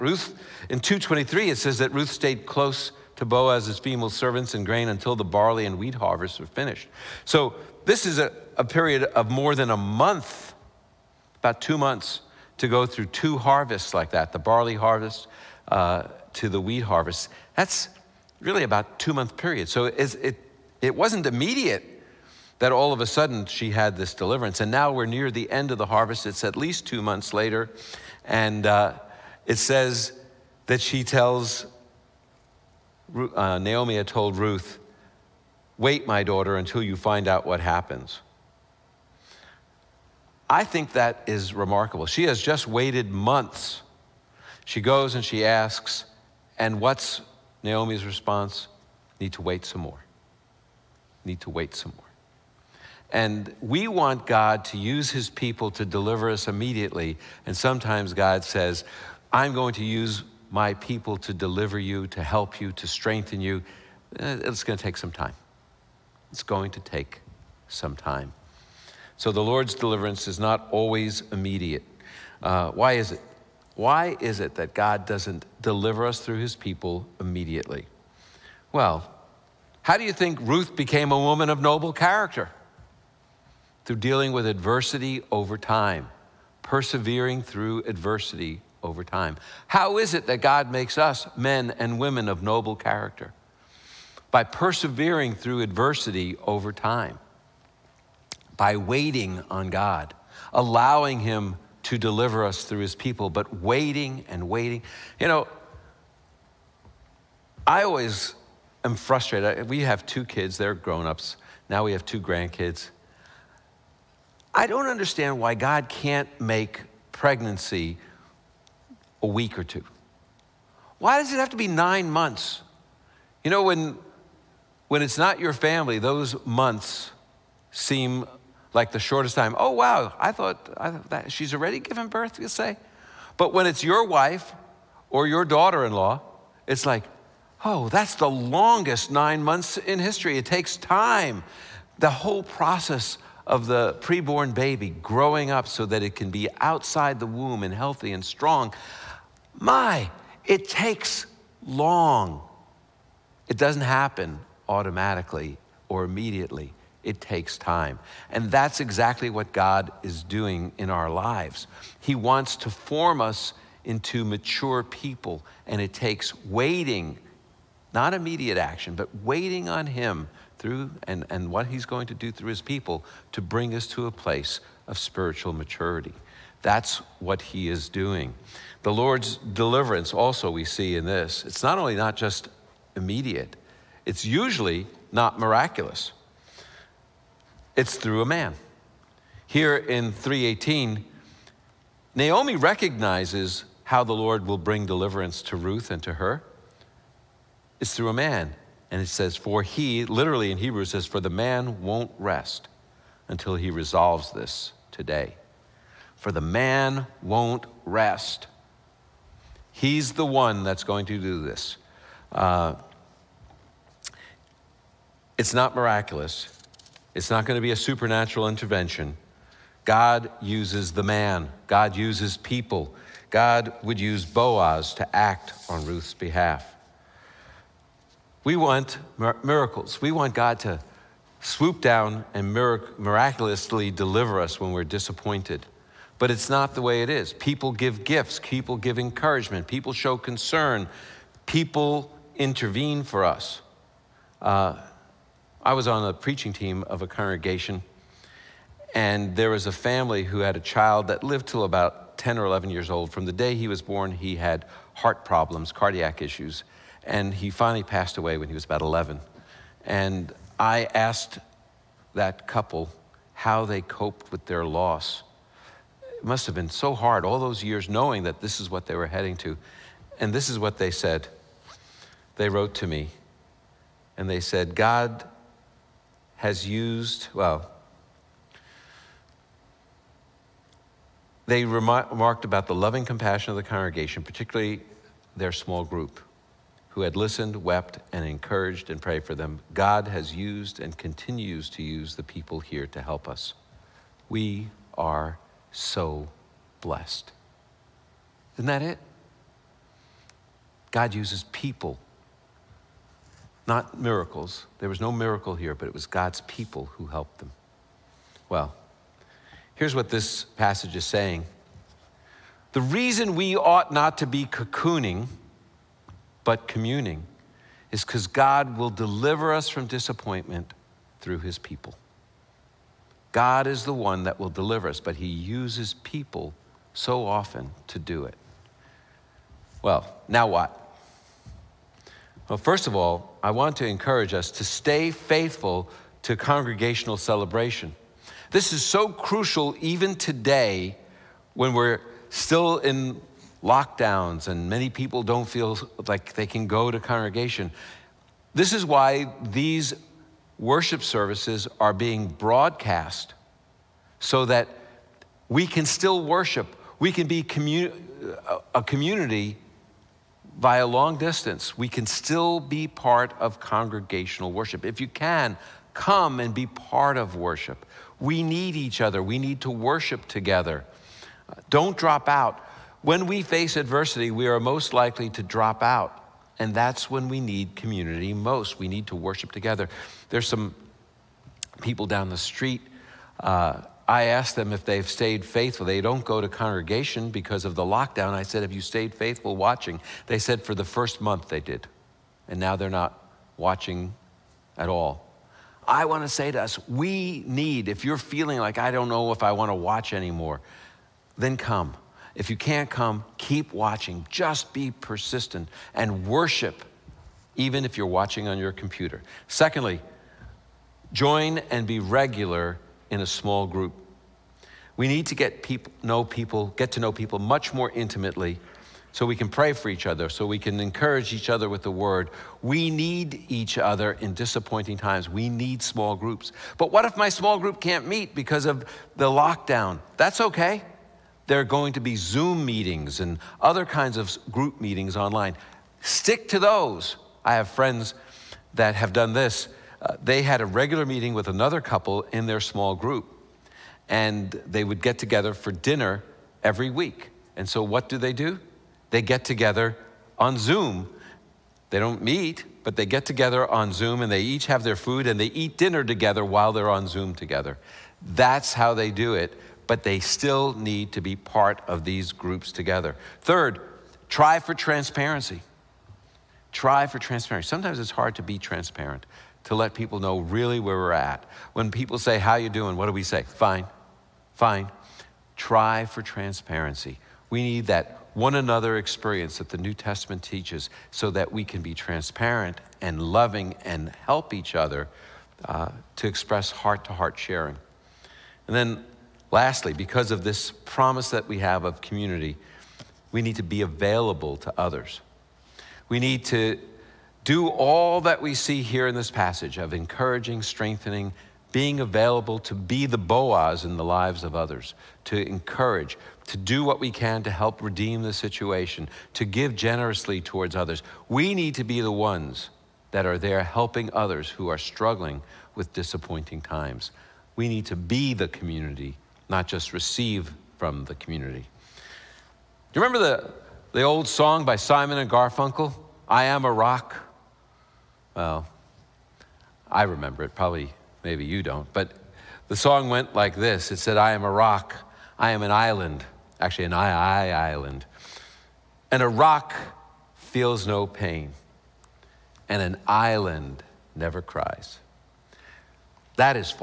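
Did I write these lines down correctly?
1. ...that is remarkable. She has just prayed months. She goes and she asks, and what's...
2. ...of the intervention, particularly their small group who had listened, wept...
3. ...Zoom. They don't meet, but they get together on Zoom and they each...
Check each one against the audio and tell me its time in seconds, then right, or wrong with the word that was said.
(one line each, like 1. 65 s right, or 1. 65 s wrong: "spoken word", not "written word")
1. 40 s wrong: "waited", not "prayed"
2. 283 s wrong: "congregation", not "intervention"
3. 450 s right.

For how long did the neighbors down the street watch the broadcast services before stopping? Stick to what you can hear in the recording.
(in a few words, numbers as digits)
The first month.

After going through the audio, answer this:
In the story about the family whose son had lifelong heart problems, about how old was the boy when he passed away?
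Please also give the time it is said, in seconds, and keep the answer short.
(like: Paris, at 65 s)
11, at 258 s.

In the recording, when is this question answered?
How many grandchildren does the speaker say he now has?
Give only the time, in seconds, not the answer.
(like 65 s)
112 s.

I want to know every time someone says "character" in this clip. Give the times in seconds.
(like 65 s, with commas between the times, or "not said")
81 s, 92 s.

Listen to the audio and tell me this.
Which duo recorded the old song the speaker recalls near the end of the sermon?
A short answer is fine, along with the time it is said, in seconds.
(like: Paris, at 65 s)
Simon and Garfunkel, at 524 s.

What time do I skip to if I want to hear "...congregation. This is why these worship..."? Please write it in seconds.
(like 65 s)
347 s.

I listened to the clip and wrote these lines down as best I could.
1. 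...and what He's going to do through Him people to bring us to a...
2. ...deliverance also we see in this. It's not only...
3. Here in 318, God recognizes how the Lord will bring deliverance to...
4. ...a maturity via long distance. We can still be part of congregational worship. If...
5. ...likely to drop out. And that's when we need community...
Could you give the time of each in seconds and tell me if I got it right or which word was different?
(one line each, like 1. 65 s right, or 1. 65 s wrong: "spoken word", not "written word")
1. 171 s wrong: "His", not "Him"
2. 179 s right
3. 189 s wrong: "Naomi", not "God"
4. 358 s wrong: "community", not "maturity"
5. 374 s right.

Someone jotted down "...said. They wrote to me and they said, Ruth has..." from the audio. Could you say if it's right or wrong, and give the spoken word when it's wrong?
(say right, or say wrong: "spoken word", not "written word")
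wrong: "God", not "Ruth".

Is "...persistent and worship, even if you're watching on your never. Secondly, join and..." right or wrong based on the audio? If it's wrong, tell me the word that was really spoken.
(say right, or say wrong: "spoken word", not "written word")
wrong: "computer", not "never".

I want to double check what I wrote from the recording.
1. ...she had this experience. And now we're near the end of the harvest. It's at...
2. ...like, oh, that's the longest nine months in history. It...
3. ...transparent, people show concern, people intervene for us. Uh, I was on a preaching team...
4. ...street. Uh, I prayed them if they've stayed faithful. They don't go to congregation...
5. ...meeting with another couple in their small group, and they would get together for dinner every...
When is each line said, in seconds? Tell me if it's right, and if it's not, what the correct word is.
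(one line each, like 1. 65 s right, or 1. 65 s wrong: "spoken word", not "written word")
1. 23 s wrong: "deliverance", not "experience"
2. 136 s right
3. 238 s wrong: "encouragement", not "transparent"
4. 382 s wrong: "asked", not "prayed"
5. 441 s right.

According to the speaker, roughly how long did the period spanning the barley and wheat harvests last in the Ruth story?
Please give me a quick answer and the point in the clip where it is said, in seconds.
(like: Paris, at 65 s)
About two months, at 11 s.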